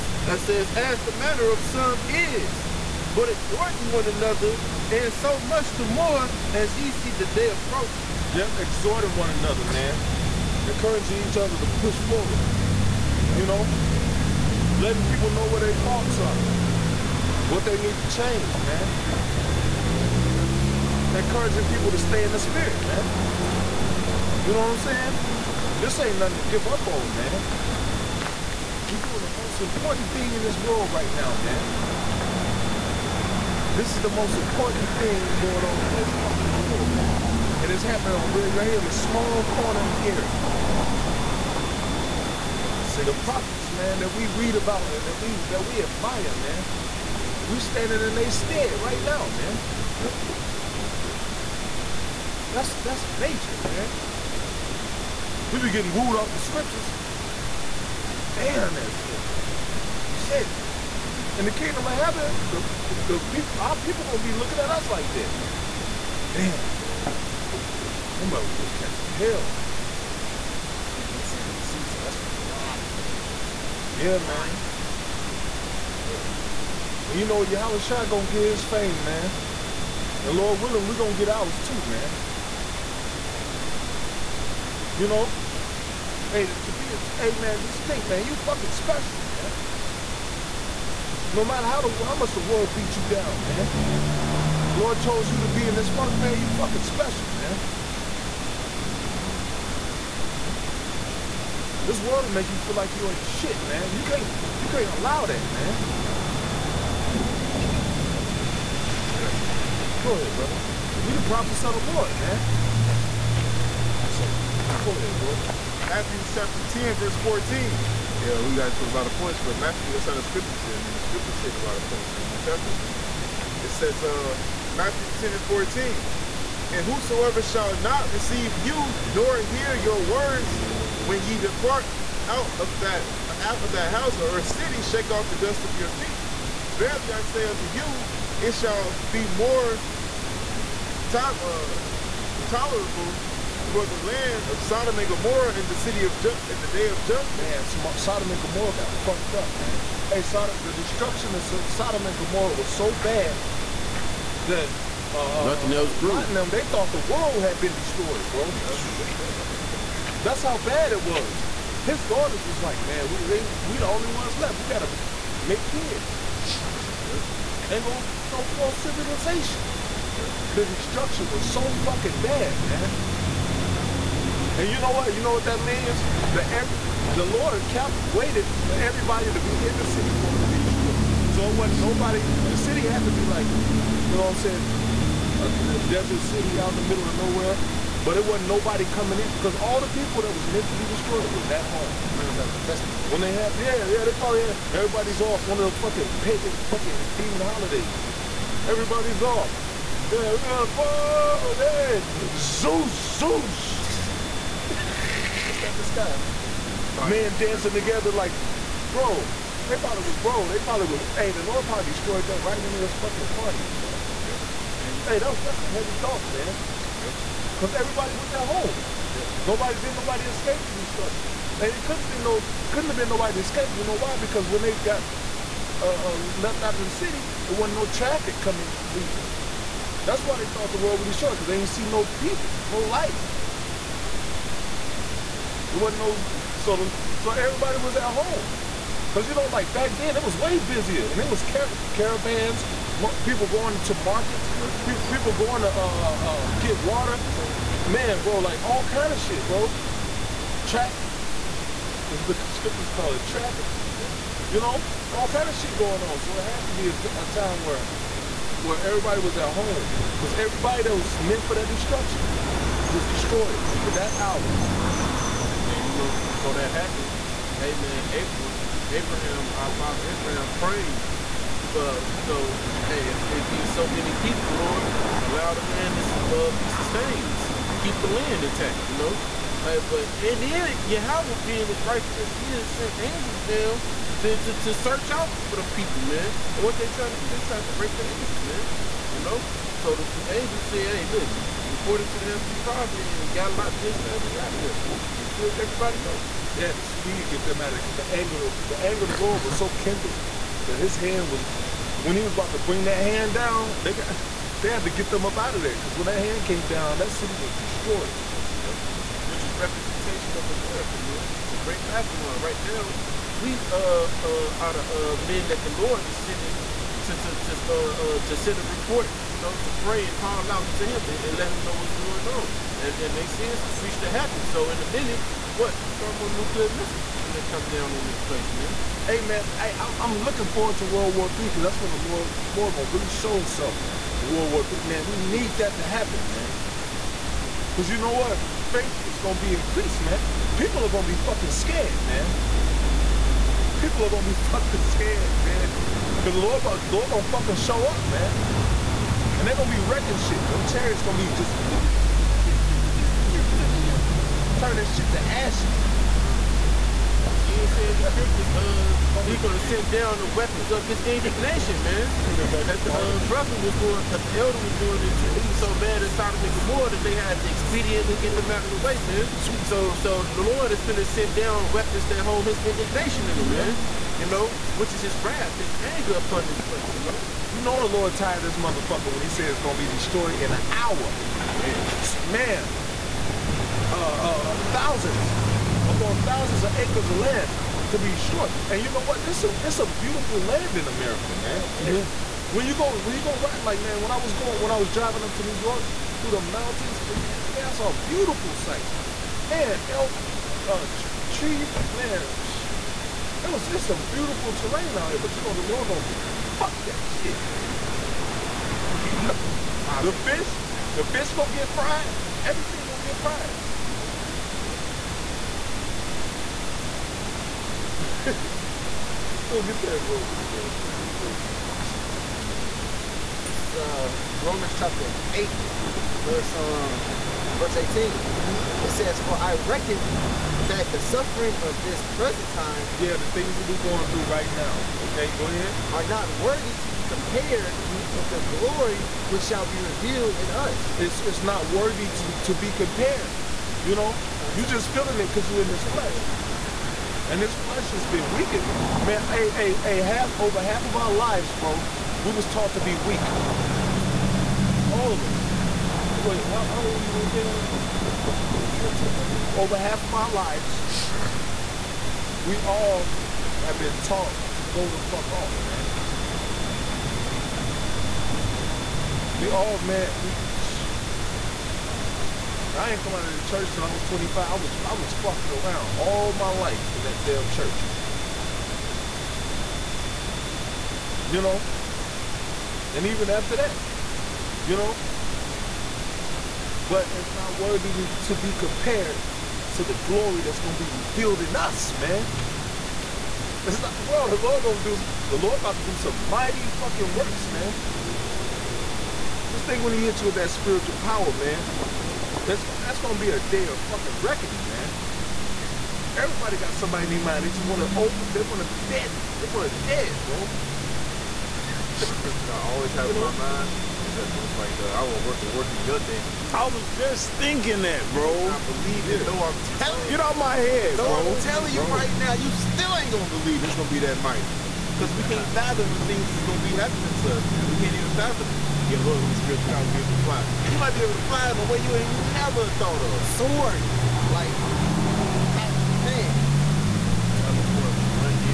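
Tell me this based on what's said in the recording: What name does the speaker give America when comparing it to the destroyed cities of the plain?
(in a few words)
The Great Babylon.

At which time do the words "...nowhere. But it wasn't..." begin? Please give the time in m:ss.
3:07.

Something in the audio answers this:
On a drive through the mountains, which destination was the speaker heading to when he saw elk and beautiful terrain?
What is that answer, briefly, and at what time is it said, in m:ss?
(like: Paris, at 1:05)
New York, at 6:35.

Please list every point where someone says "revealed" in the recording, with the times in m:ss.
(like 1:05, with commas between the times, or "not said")
7:19, 8:10.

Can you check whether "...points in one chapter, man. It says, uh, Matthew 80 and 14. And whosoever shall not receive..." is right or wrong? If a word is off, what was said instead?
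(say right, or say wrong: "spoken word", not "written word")
wrong: "10", not "80".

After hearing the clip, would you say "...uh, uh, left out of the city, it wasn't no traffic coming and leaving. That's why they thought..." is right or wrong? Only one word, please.
right.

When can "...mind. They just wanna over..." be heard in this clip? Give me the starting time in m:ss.
8:27.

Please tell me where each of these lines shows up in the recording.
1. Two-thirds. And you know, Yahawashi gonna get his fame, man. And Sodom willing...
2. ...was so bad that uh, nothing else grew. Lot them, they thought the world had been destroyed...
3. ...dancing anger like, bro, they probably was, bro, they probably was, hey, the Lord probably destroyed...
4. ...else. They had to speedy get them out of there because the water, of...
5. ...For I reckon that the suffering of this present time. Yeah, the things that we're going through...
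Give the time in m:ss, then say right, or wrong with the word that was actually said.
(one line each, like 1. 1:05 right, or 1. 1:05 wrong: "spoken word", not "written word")
1. 1:15 wrong: "Lord", not "Sodom"
2. 2:32 right
3. 3:27 wrong: "together", not "anger"
4. 4:56 wrong: "anger", not "water"
5. 7:09 right.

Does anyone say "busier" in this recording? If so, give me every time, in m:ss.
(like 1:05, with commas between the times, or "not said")
4:00.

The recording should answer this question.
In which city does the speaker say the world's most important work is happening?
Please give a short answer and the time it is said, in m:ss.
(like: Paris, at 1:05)
Gary, at 0:40.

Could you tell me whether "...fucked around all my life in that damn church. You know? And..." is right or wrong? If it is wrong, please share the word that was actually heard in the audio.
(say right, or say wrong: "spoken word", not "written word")
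right.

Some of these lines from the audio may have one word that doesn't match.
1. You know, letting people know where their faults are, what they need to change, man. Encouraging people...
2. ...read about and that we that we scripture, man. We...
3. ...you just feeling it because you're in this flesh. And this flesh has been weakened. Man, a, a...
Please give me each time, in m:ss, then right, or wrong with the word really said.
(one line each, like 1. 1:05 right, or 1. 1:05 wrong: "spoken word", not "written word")
1. 0:13 right
2. 0:44 wrong: "admire", not "scripture"
3. 7:24 right.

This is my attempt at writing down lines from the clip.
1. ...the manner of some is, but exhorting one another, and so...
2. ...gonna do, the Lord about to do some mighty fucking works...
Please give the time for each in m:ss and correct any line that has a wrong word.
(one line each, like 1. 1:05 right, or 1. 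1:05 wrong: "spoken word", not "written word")
1. 0:00 right
2. 8:14 right.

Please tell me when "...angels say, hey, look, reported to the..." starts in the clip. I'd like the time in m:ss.
4:50.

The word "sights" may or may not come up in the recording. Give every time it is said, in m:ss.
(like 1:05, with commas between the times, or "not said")
6:38.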